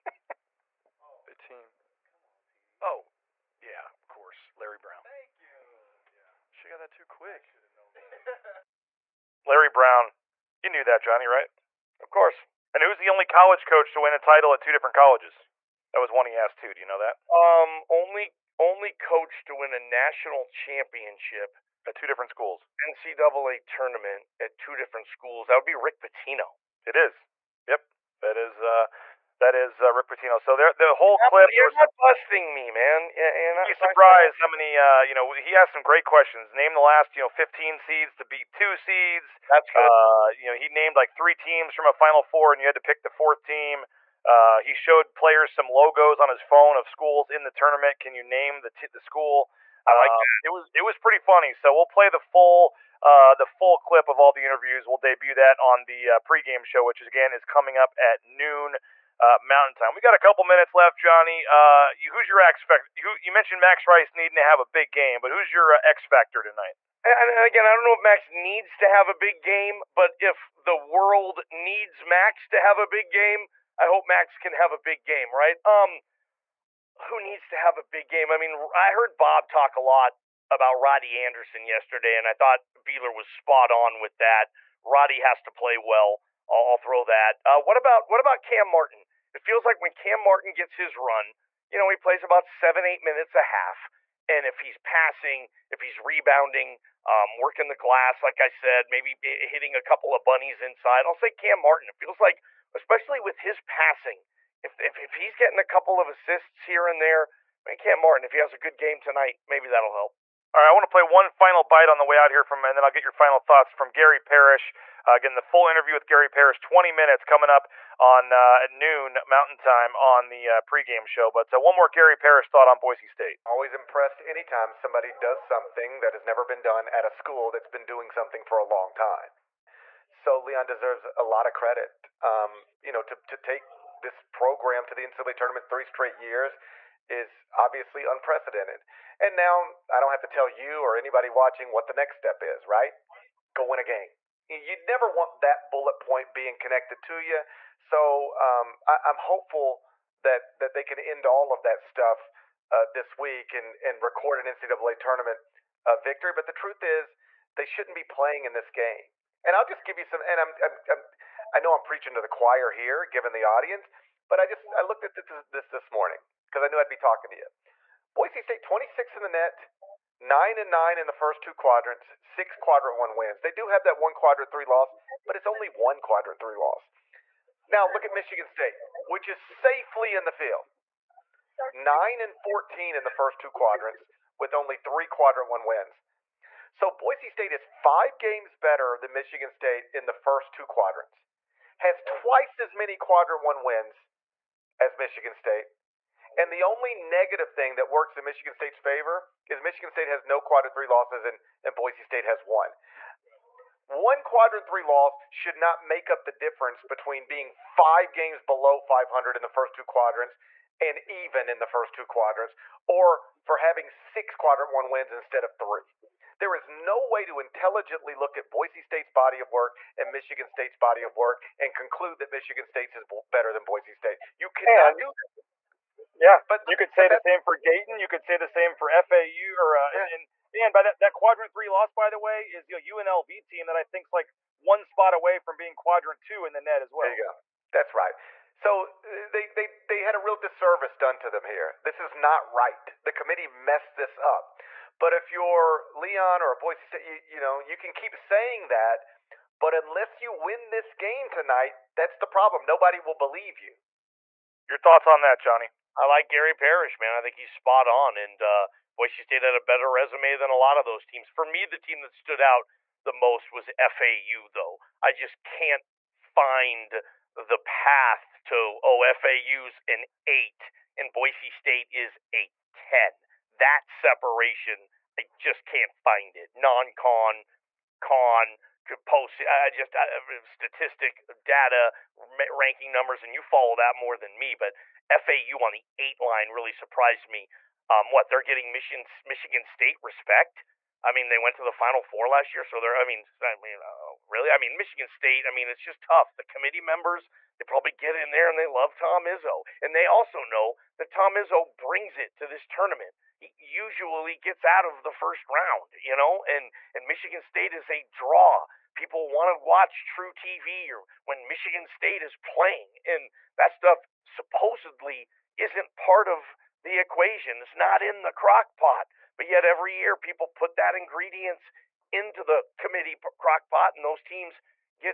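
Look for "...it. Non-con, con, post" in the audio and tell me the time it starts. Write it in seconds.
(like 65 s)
276 s.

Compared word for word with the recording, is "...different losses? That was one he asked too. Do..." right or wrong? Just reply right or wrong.
wrong.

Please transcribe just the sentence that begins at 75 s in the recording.
Um, who needs to have a big game?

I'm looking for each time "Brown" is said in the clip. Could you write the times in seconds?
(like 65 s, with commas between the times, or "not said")
4 s, 9 s.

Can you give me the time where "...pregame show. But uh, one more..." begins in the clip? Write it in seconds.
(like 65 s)
120 s.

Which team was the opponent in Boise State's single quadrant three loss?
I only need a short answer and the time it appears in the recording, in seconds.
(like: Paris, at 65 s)
UNLV, at 232 s.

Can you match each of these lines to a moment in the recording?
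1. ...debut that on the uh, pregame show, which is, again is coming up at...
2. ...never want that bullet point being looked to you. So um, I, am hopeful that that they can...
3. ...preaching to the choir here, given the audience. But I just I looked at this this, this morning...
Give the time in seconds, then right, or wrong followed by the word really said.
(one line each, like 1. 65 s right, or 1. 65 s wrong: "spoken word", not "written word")
1. 54 s right
2. 144 s wrong: "connected", not "looked"
3. 161 s right.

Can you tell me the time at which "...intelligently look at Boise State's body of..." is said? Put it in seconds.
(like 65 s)
217 s.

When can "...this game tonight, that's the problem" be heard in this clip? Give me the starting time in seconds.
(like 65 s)
250 s.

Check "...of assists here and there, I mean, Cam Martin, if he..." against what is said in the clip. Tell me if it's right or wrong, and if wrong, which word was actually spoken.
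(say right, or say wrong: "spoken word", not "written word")
right.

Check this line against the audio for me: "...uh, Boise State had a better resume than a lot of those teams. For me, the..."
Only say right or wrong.
right.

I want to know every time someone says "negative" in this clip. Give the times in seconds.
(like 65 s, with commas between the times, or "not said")
196 s.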